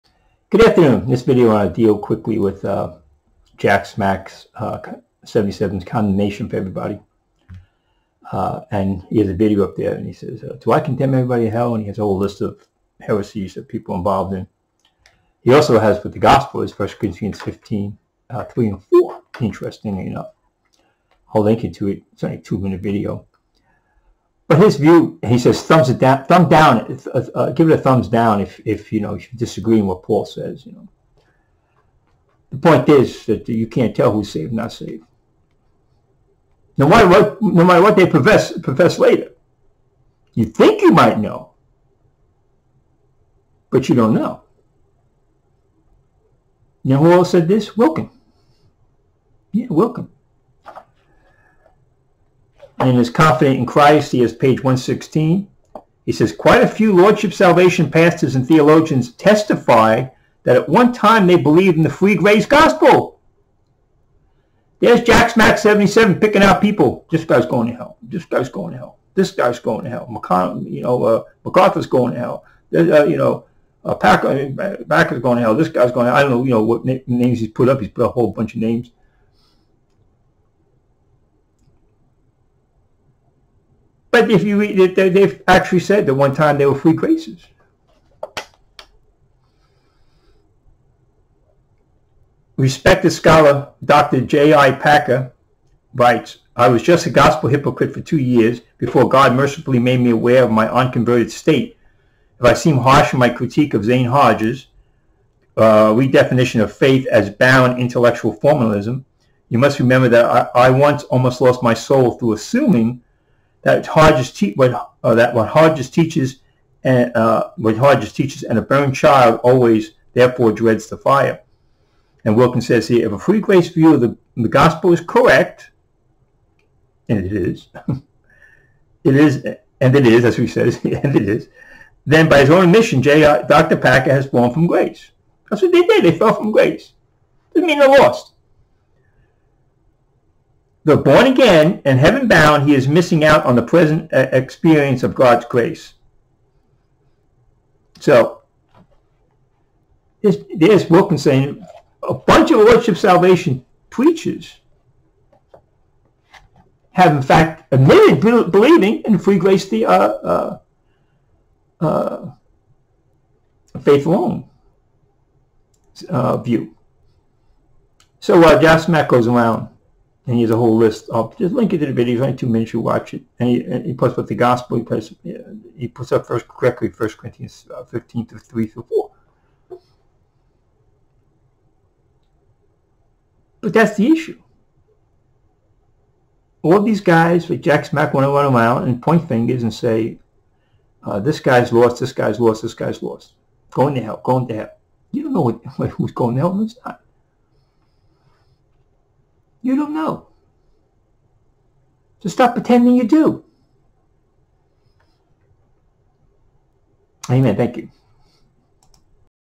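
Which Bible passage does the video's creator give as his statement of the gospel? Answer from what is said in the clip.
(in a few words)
1 Corinthians 15:3-4.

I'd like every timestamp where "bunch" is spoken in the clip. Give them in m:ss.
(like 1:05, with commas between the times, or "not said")
1:18, 2:32.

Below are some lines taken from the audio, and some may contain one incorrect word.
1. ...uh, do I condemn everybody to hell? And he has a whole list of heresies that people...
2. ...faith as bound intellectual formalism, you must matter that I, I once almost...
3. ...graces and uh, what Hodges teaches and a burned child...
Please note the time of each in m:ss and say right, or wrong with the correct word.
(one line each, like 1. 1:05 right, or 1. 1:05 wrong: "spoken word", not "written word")
1. 0:10 right
2. 1:46 wrong: "remember", not "matter"
3. 1:55 wrong: "teaches", not "graces".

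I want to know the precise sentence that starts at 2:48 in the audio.
So uh, Josh goes around and he has a whole list of Just link it to the video.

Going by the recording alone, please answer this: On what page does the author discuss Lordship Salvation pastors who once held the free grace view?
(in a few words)
116.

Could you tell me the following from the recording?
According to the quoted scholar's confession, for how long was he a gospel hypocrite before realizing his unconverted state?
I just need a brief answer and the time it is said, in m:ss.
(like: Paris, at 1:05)
two years, at 1:38.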